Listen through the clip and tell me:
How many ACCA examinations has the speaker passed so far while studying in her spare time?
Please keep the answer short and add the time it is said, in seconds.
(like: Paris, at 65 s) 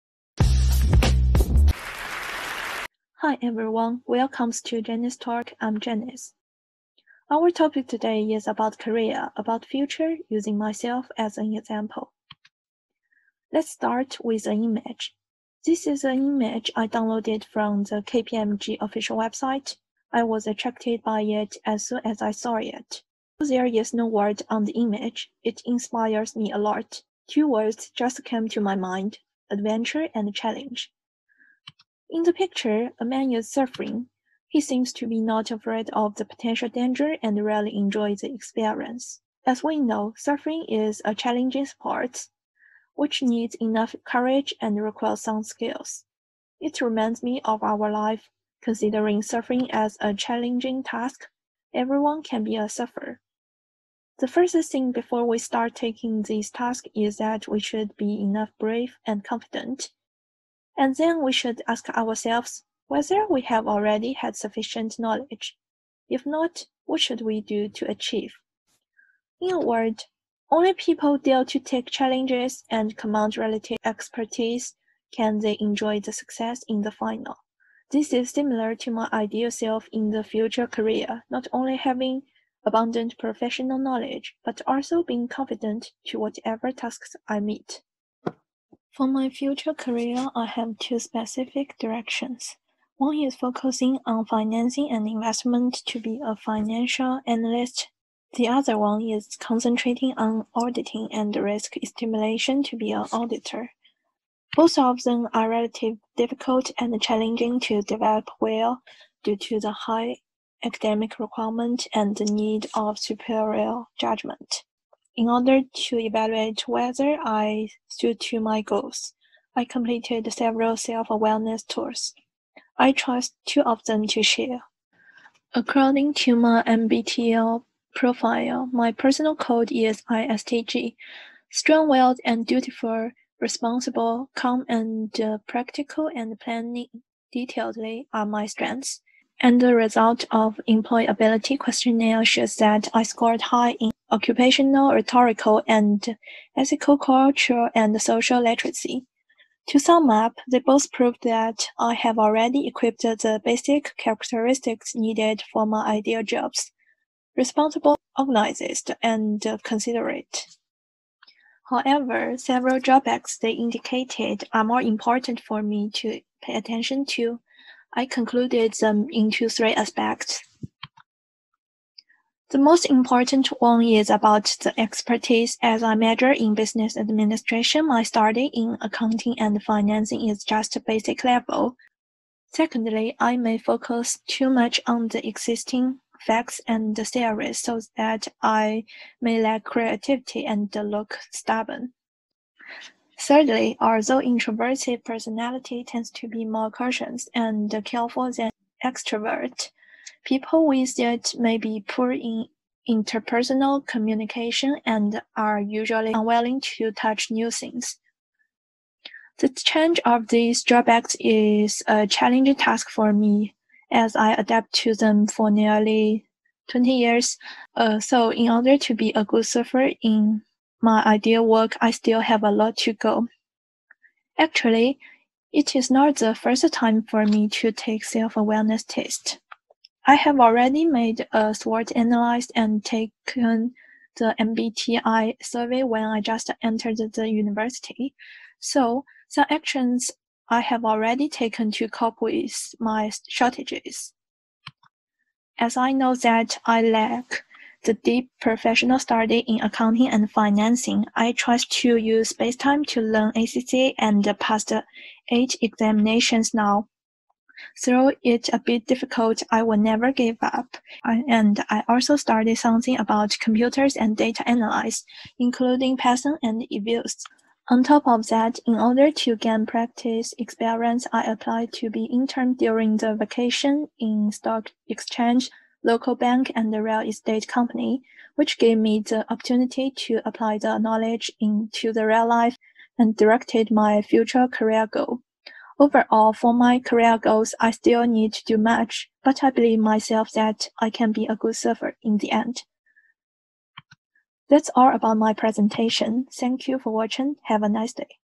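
8, at 255 s.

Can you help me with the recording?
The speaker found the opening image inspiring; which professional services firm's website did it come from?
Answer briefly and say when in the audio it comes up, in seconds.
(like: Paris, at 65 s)
KPMG, at 18 s.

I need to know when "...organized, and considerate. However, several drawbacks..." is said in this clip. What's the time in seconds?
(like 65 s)
158 s.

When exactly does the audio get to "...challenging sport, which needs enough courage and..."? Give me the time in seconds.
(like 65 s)
41 s.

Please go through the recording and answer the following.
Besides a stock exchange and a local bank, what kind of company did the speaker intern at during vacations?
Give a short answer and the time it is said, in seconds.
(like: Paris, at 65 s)
real estate company, at 276 s.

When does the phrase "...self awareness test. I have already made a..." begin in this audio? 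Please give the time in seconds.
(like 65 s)
228 s.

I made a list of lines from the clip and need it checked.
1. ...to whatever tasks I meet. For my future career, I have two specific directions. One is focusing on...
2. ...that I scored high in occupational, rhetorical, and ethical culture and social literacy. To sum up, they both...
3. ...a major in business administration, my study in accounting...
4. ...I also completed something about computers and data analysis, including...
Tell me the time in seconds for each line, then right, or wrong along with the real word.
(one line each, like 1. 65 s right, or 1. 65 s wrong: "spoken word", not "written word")
1. 86 s right
2. 142 s right
3. 175 s right
4. 261 s wrong: "studied", not "completed".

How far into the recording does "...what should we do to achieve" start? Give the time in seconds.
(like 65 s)
66 s.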